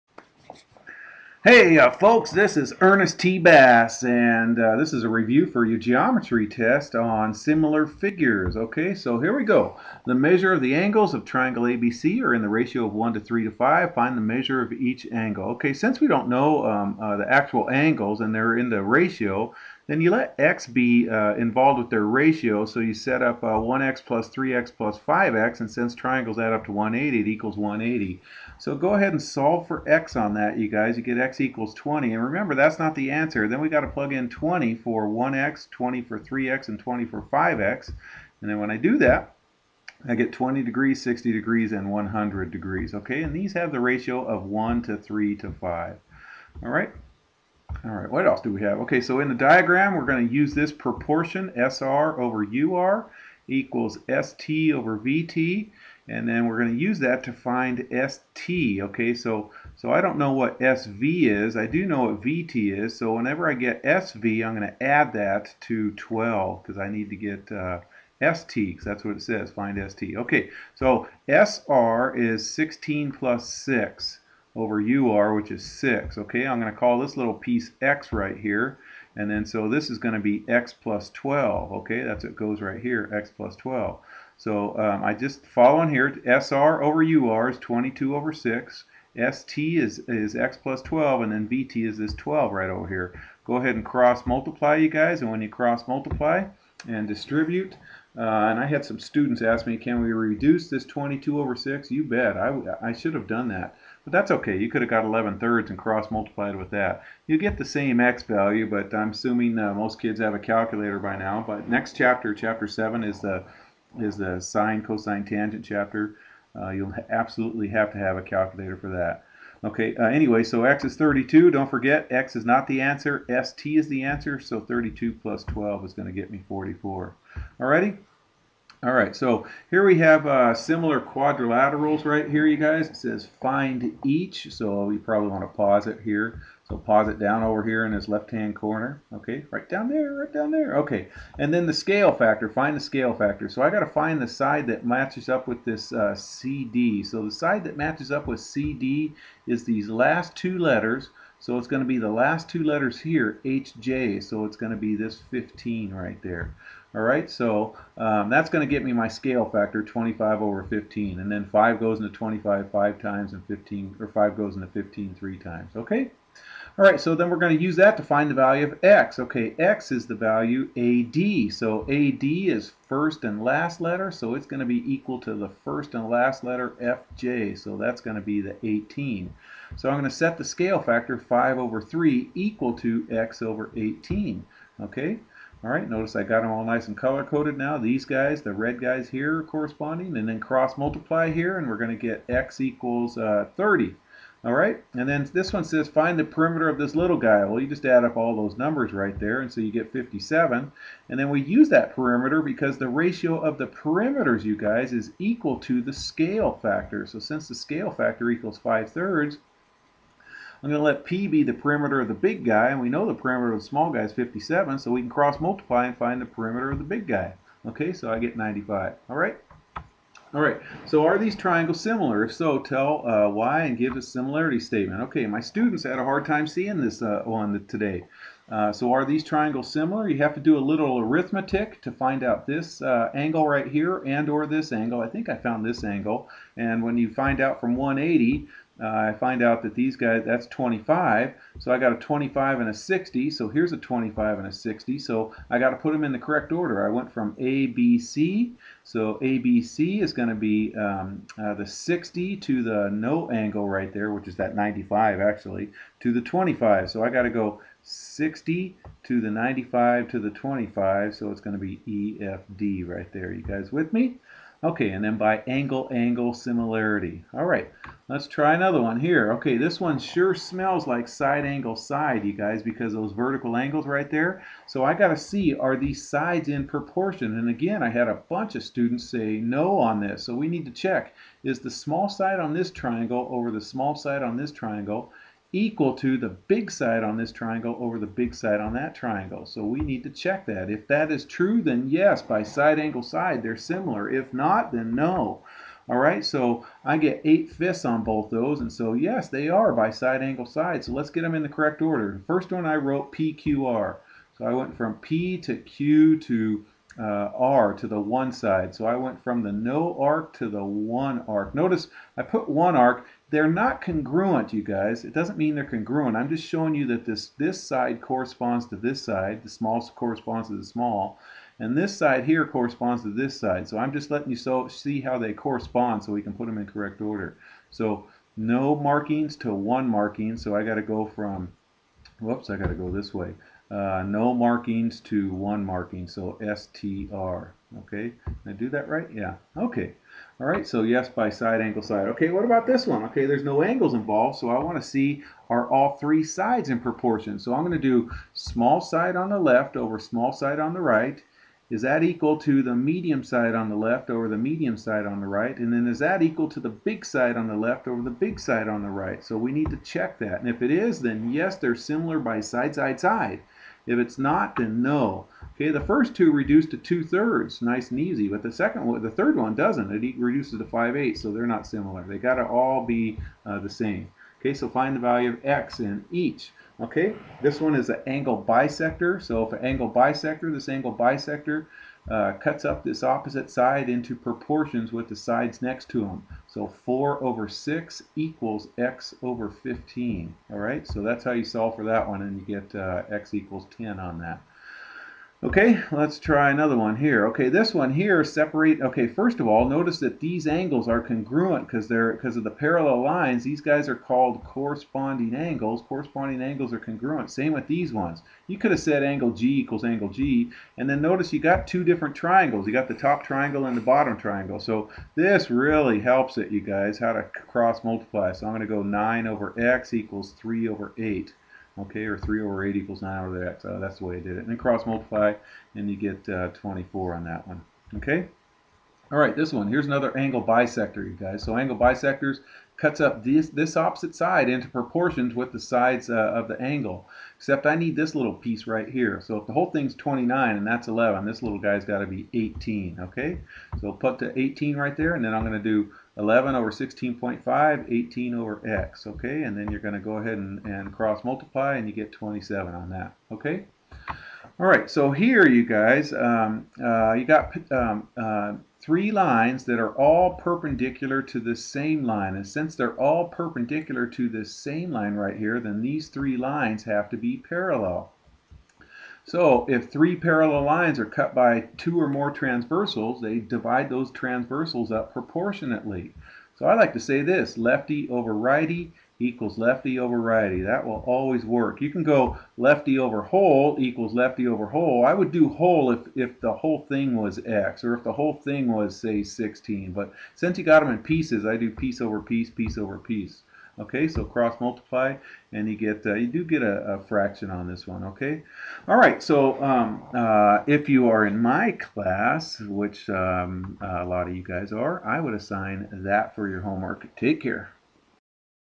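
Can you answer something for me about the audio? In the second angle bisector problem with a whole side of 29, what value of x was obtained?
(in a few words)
27.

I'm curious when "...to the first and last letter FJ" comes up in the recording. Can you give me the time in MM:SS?
02:55.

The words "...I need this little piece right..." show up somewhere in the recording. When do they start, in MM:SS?
07:17.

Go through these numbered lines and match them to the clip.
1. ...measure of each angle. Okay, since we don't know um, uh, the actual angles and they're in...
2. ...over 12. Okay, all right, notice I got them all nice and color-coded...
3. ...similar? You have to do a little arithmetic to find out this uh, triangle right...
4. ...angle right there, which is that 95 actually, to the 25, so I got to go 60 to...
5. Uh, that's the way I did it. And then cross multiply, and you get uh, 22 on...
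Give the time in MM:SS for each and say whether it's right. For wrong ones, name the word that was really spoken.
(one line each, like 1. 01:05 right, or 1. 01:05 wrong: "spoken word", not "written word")
1. 00:14 right
2. 03:03 wrong: "18", not "12"
3. 03:49 wrong: "angle", not "triangle"
4. 04:13 right
5. 07:03 wrong: "24", not "22".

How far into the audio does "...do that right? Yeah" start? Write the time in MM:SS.
05:38.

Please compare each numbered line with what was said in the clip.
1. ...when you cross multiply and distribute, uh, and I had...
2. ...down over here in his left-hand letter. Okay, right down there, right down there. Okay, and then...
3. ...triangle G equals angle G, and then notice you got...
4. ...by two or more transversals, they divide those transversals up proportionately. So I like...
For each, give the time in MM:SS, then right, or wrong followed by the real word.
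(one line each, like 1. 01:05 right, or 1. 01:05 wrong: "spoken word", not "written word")
1. 01:35 right
2. 02:17 wrong: "corner", not "letter"
3. 06:49 wrong: "angle", not "triangle"
4. 07:51 right.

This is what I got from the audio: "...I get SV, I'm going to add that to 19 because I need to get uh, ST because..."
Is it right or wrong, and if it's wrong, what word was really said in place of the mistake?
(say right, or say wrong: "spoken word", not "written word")
wrong: "12", not "19".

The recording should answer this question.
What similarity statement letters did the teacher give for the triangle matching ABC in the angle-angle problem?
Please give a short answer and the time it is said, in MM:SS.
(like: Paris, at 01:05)
EFD, at 04:22.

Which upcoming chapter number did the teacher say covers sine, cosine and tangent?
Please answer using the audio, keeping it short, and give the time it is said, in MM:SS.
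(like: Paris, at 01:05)
7, at 01:52.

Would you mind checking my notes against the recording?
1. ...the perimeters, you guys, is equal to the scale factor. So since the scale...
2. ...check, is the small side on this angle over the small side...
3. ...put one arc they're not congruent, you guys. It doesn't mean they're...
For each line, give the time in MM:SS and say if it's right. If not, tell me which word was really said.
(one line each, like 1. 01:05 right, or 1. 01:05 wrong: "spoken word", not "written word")
1. 03:23 right
2. 04:40 wrong: "triangle", not "angle"
3. 05:12 right.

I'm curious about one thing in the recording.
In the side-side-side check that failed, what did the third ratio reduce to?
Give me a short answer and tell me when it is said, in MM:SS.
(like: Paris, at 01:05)
5/8, at 06:10.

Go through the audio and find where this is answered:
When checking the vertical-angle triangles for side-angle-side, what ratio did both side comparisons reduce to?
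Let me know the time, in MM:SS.
04:57.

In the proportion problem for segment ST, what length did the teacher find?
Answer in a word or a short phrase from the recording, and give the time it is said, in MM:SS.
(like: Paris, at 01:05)
44, at 02:06.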